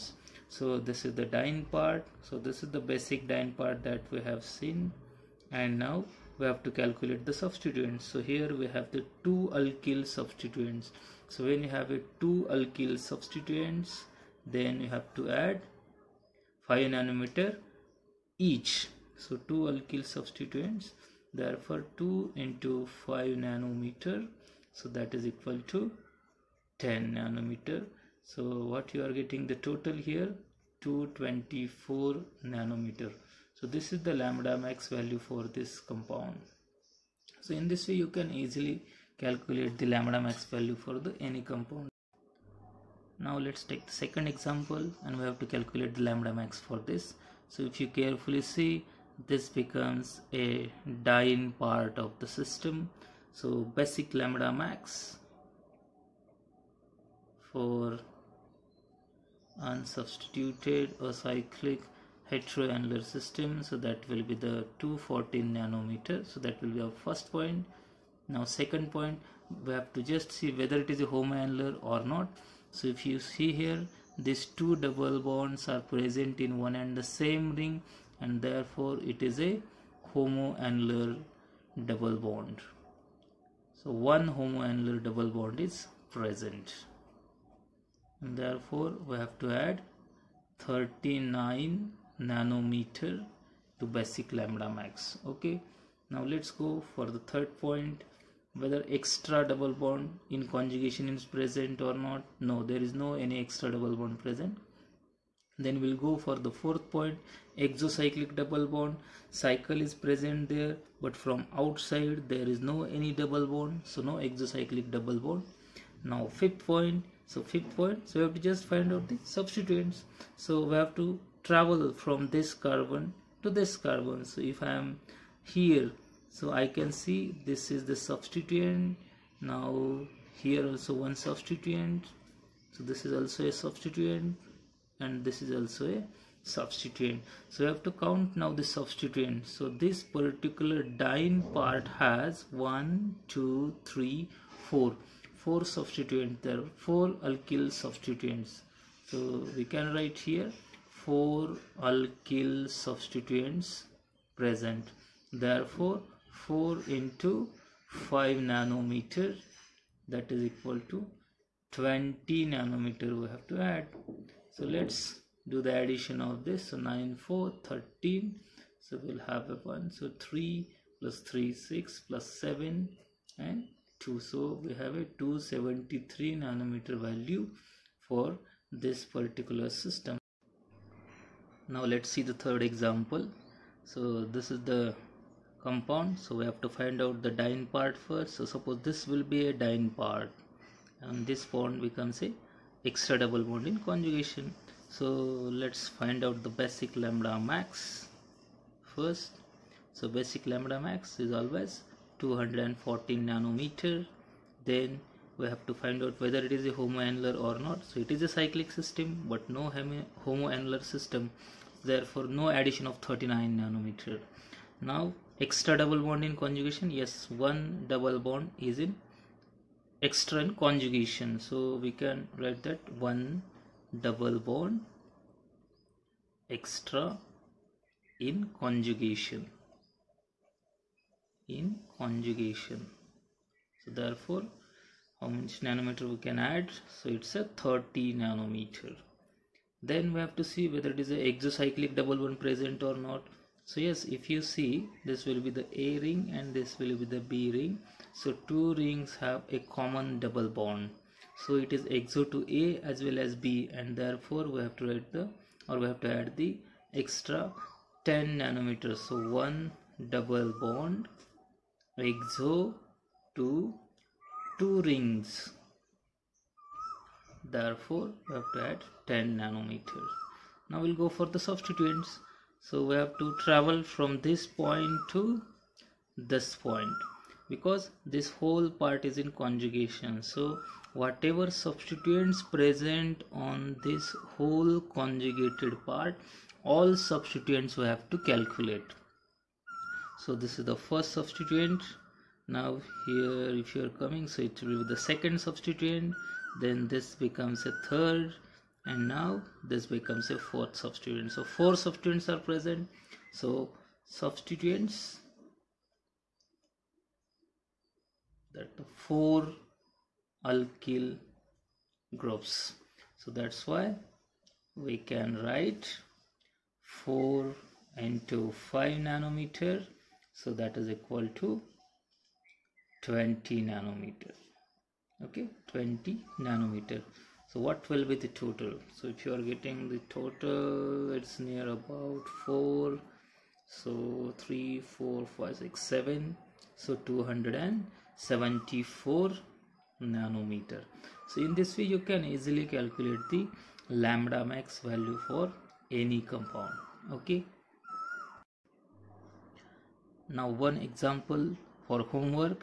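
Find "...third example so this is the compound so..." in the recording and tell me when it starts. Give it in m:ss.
3:02.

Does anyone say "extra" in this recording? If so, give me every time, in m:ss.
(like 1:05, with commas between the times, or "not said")
1:38, 1:43, 3:12, 3:35, 3:40, 3:46, 4:17.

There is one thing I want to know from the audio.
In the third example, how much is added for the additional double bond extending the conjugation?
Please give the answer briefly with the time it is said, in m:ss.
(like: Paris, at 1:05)
30 nanometer, at 3:57.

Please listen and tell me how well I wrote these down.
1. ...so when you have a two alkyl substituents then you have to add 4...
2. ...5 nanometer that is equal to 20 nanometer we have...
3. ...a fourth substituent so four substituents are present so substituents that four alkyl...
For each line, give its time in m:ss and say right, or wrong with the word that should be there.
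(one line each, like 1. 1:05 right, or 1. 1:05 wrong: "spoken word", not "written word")
1. 0:11 wrong: "5", not "4"
2. 2:38 right
3. 5:00 right.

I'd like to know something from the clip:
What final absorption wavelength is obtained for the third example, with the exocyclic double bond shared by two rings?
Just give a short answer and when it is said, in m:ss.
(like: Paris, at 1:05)
274 nanometer, at 5:37.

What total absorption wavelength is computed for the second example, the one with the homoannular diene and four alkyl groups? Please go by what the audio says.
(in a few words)
273 nanometer.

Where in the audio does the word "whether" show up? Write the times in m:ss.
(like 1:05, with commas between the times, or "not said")
1:10, 1:38, 3:26, 4:00.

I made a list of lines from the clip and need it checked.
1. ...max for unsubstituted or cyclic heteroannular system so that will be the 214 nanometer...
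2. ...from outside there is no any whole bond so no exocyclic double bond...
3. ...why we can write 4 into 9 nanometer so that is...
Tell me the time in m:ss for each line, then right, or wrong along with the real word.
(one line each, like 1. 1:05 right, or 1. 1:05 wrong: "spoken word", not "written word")
1. 0:54 right
2. 1:51 wrong: "double", not "whole"
3. 5:13 wrong: "5", not "9".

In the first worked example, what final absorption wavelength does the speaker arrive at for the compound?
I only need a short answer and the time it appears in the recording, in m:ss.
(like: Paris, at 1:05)
224 nanometer, at 0:30.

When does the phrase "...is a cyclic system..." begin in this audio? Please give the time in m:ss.
3:28.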